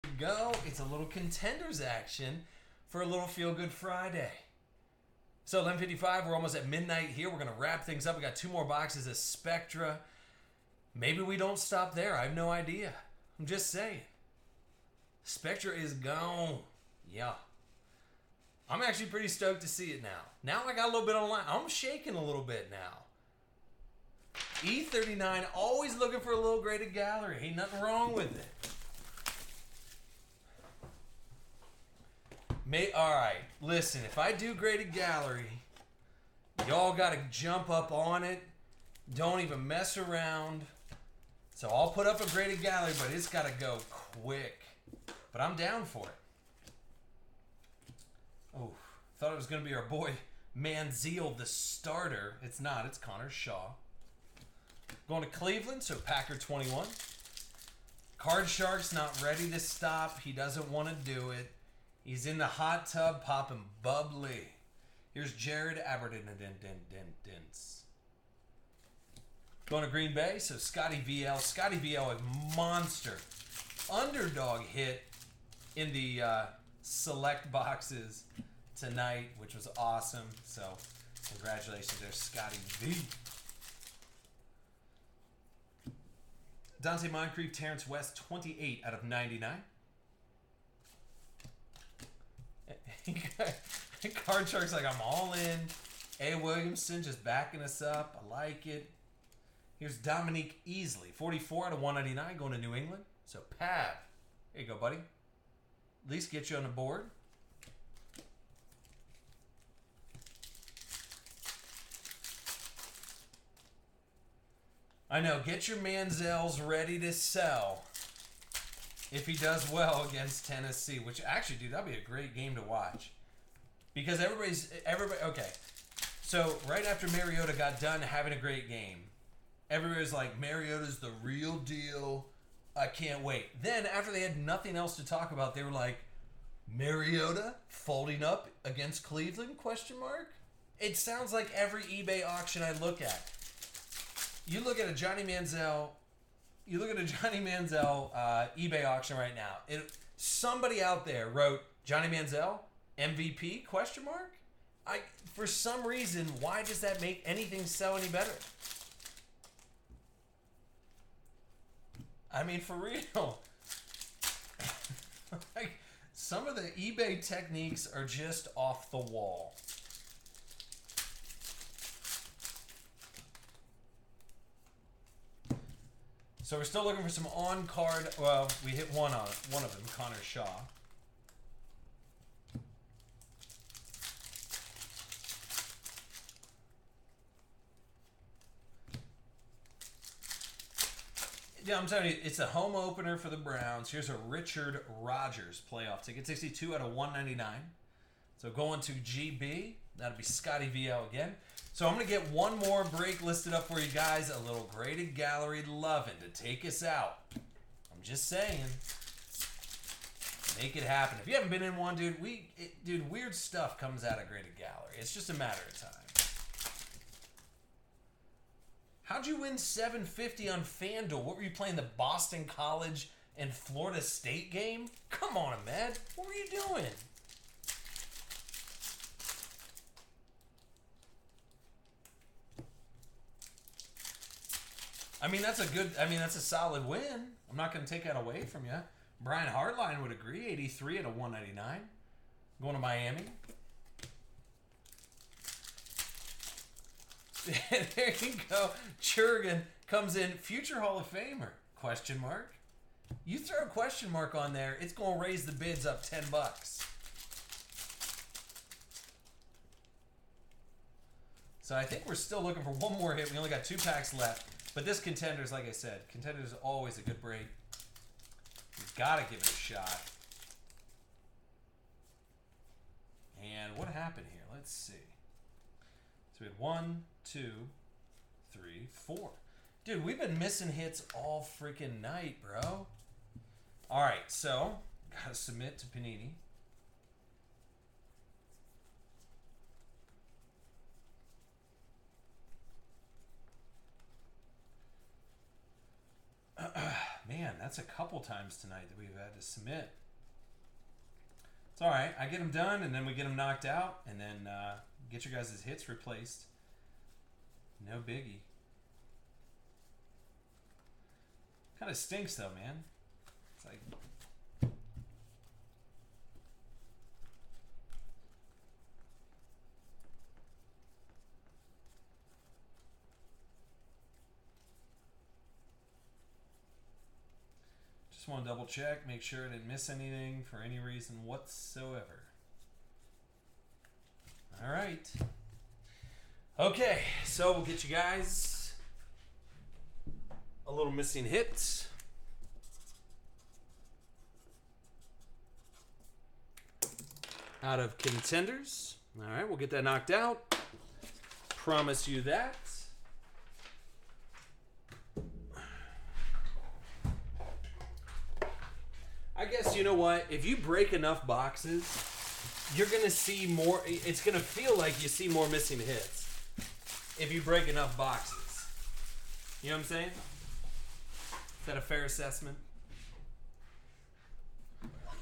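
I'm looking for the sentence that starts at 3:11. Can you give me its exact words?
Yeah, I'm telling you, it's a home opener for the Browns.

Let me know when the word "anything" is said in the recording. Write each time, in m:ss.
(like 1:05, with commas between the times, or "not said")
2:37, 5:29.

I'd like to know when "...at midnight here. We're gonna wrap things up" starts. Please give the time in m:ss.
0:06.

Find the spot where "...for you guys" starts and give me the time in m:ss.
3:23.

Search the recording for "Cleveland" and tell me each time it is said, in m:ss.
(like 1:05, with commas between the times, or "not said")
0:55, 2:19.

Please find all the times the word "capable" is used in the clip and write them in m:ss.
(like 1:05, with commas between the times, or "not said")
not said.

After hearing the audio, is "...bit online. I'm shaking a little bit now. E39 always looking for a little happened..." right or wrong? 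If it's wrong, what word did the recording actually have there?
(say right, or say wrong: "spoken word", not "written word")
wrong: "graded", not "happened".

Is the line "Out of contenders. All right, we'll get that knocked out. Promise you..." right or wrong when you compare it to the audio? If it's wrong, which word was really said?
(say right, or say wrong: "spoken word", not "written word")
right.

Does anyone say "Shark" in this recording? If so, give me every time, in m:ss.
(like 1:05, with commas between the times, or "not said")
0:58, 1:34.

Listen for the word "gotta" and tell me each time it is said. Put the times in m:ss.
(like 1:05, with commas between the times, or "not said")
4:28, 4:45.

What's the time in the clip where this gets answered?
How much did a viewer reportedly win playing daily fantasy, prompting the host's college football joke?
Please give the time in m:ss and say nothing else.
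3:39.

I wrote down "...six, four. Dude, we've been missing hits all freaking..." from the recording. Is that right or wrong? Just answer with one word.
wrong.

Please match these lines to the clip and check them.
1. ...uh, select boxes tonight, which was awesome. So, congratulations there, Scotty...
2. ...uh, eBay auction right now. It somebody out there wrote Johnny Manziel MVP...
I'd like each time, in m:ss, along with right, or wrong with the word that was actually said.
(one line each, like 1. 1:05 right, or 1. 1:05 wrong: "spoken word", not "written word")
1. 1:16 right
2. 2:28 right.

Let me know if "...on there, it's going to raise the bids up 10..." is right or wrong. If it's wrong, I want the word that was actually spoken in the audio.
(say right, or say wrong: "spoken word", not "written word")
right.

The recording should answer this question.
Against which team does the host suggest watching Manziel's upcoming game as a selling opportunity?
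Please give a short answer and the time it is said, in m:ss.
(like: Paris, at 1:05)
Tennessee, at 2:00.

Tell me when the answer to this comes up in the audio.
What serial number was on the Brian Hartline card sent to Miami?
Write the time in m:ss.
4:00.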